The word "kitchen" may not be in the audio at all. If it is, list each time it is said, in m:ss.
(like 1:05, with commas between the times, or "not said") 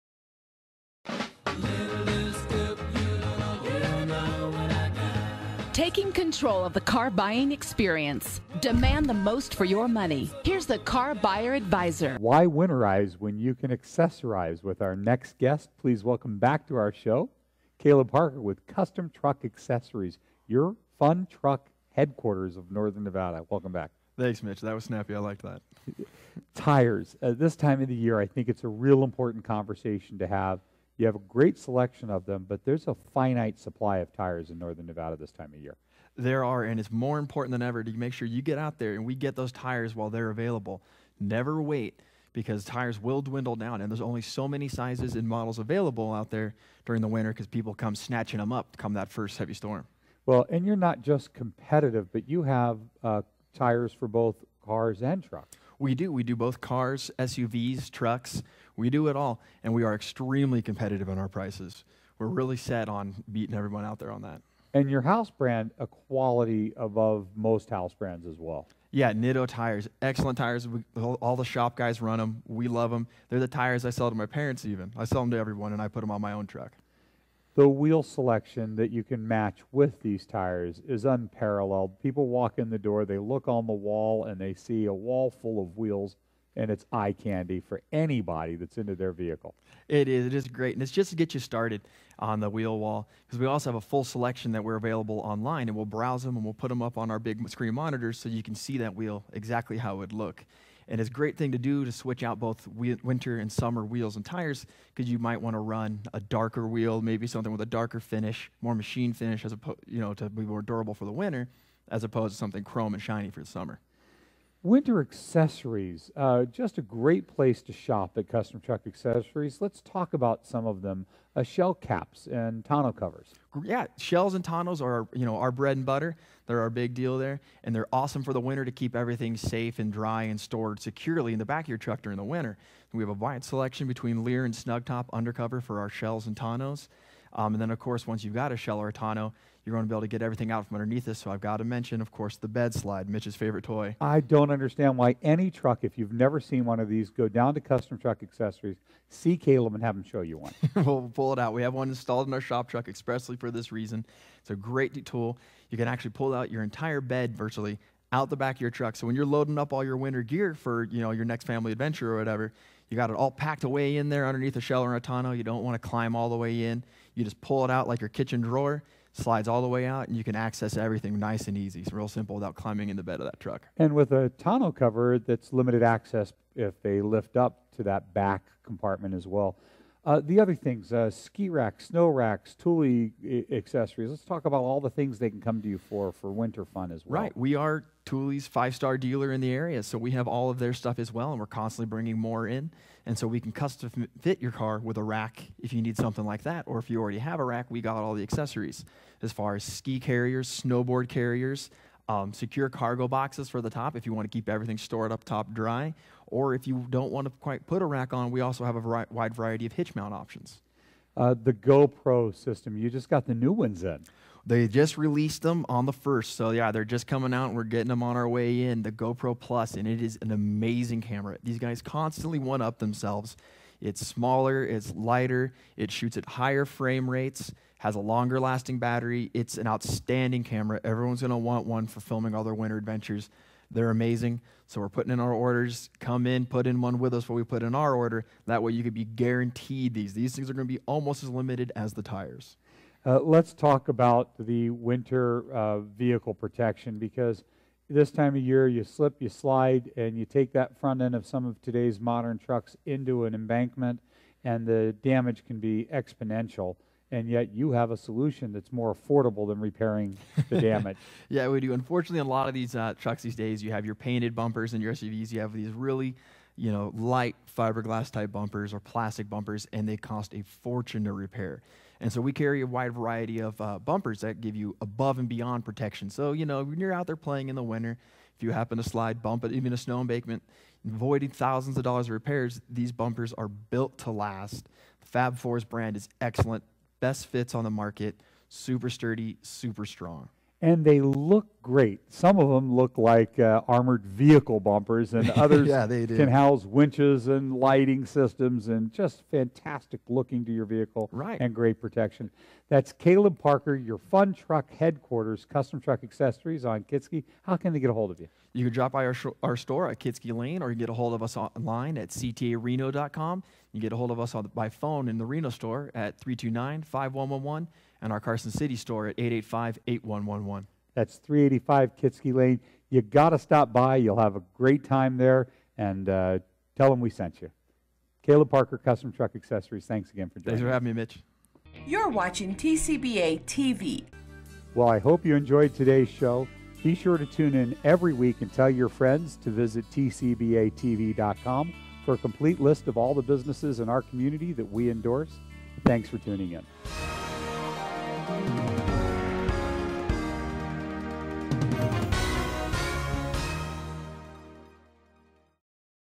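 2:48.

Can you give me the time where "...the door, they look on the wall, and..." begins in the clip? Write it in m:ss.
1:22.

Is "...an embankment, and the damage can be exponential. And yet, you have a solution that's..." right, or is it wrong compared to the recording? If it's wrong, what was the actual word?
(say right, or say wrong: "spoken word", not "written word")
right.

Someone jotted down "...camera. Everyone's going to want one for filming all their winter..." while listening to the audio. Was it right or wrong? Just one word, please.
right.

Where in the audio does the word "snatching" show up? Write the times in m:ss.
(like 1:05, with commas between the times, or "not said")
0:47.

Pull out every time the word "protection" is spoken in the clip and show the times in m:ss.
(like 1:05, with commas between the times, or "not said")
4:06, 4:35, 5:01.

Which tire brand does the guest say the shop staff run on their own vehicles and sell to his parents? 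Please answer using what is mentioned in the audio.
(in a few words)
Nitto.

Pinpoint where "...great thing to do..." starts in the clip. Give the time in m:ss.
1:41.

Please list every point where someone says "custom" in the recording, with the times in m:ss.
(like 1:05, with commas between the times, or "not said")
0:18, 1:58, 2:27, 3:13, 5:05, 5:28.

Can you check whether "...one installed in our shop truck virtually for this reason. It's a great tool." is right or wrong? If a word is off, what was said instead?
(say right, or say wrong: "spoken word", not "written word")
wrong: "expressly", not "virtually".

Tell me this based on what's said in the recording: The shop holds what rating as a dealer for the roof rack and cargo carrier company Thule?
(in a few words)
five star.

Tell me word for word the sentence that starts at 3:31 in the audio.
Uh, the GoPro system, you just got the new ones in.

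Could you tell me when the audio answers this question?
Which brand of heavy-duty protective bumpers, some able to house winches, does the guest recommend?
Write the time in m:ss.
4:45.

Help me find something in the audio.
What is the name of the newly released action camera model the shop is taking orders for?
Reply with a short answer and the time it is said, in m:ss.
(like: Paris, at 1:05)
GoPro Plus, at 3:38.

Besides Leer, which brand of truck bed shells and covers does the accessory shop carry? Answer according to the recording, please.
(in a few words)
Snugtop.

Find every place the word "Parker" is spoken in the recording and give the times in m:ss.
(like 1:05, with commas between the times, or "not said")
0:18, 5:03, 5:28.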